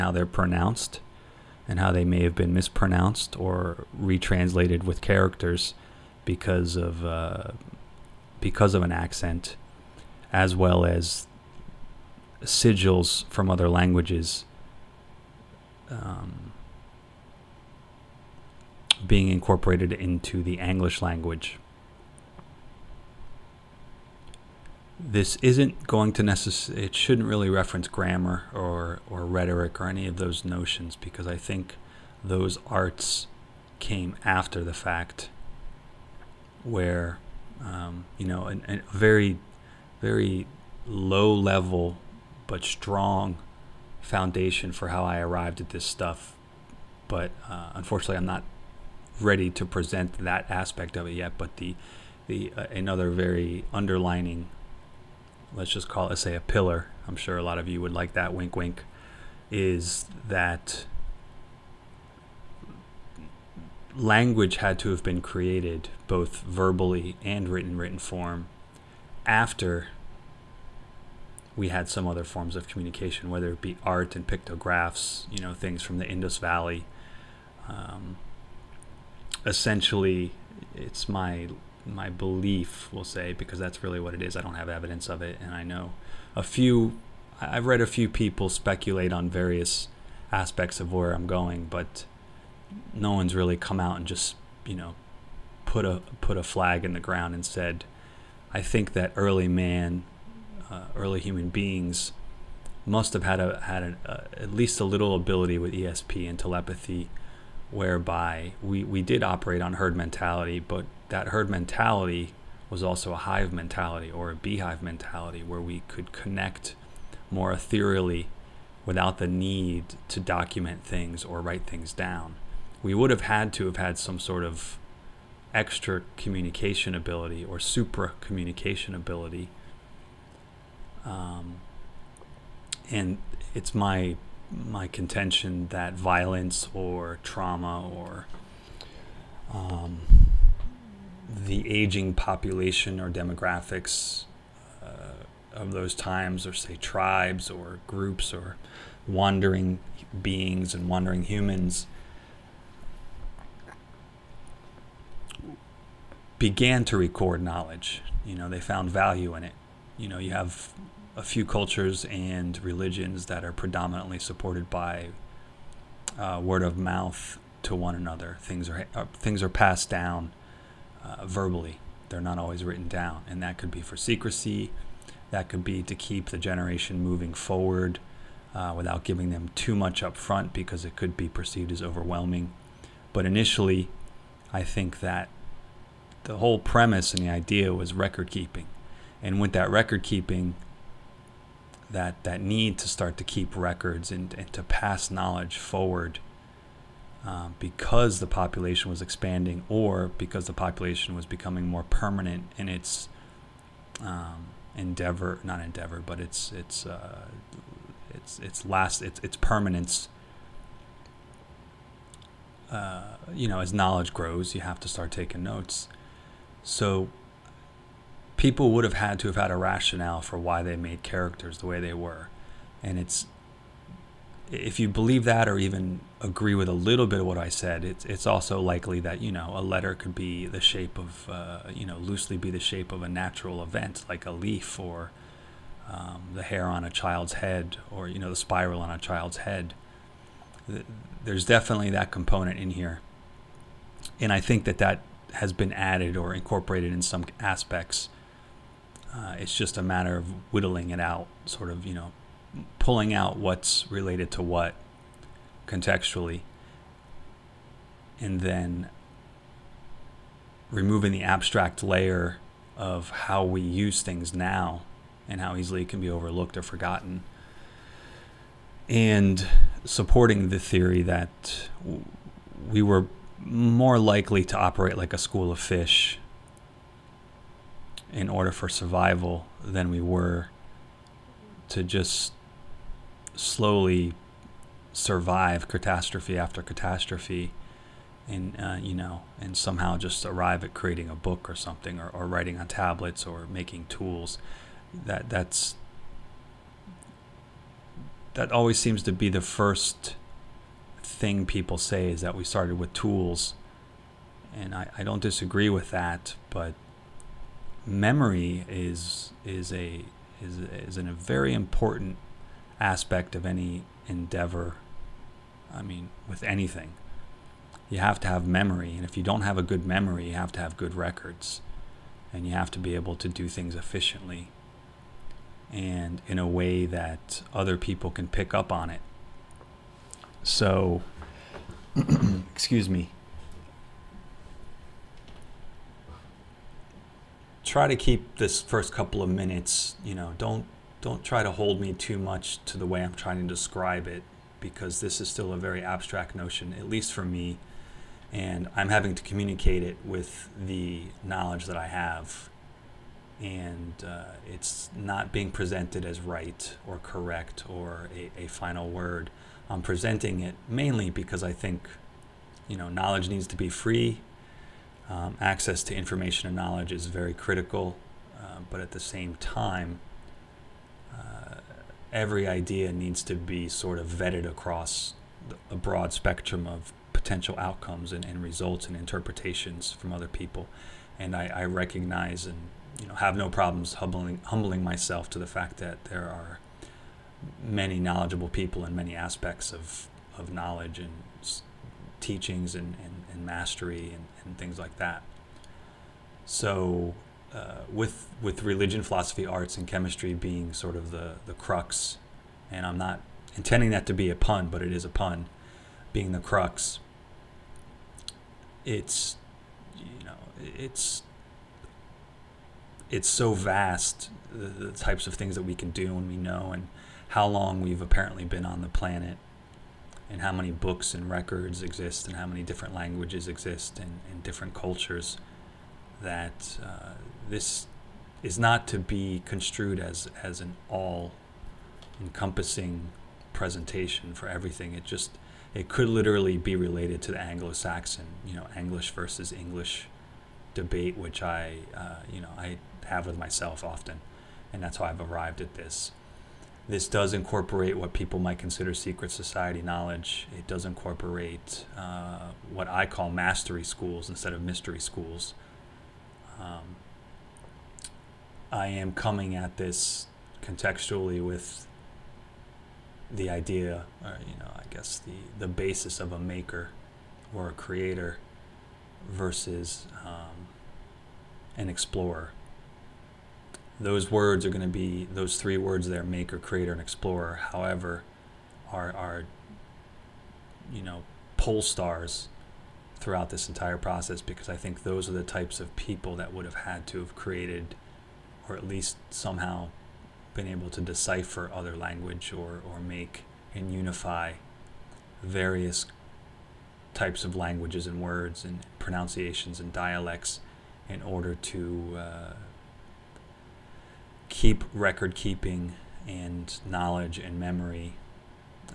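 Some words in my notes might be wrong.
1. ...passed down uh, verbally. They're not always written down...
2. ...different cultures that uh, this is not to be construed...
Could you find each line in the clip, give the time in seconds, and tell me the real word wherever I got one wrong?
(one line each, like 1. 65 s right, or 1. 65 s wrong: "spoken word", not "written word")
1. 169 s right
2. 424 s right.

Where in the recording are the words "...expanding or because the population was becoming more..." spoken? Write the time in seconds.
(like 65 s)
199 s.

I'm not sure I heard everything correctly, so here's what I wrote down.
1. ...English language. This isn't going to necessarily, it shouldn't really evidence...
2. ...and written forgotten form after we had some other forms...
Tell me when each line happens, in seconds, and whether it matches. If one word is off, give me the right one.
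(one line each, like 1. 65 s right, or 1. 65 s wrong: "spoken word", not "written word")
1. 20 s wrong: "reference", not "evidence"
2. 67 s wrong: "written", not "forgotten".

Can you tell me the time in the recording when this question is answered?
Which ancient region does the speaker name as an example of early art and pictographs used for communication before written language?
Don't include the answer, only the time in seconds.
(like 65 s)
76 s.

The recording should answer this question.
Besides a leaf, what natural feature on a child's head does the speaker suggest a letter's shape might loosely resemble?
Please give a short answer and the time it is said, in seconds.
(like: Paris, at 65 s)
the spiral, at 238 s.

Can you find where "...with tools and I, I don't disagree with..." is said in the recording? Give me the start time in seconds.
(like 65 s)
302 s.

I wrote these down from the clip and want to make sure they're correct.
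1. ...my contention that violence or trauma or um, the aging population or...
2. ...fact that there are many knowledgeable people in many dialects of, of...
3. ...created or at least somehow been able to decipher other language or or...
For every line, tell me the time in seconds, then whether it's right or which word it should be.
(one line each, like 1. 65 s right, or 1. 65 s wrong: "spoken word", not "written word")
1. 134 s right
2. 385 s wrong: "aspects", not "dialects"
3. 487 s right.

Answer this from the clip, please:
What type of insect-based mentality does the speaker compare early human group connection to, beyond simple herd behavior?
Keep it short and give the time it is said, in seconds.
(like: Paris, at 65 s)
beehive mentality, at 114 s.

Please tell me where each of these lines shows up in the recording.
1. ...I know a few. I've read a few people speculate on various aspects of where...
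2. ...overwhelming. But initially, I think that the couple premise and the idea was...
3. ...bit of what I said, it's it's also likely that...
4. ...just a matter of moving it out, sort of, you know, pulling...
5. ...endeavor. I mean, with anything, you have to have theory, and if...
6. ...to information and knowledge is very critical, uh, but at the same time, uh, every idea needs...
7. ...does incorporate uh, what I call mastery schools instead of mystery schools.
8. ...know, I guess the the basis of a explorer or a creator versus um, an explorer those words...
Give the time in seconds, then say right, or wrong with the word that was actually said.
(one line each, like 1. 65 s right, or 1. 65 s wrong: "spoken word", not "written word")
1. 85 s right
2. 181 s wrong: "whole", not "couple"
3. 227 s right
4. 249 s wrong: "whittling", not "moving"
5. 314 s wrong: "memory", not "theory"
6. 365 s right
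7. 450 s right
8. 464 s wrong: "maker", not "explorer".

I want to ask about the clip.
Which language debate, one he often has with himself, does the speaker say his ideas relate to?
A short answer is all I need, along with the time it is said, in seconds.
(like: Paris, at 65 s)
Anglo-Saxon, at 437 s.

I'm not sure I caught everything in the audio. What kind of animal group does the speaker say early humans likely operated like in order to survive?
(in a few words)
a school of fish.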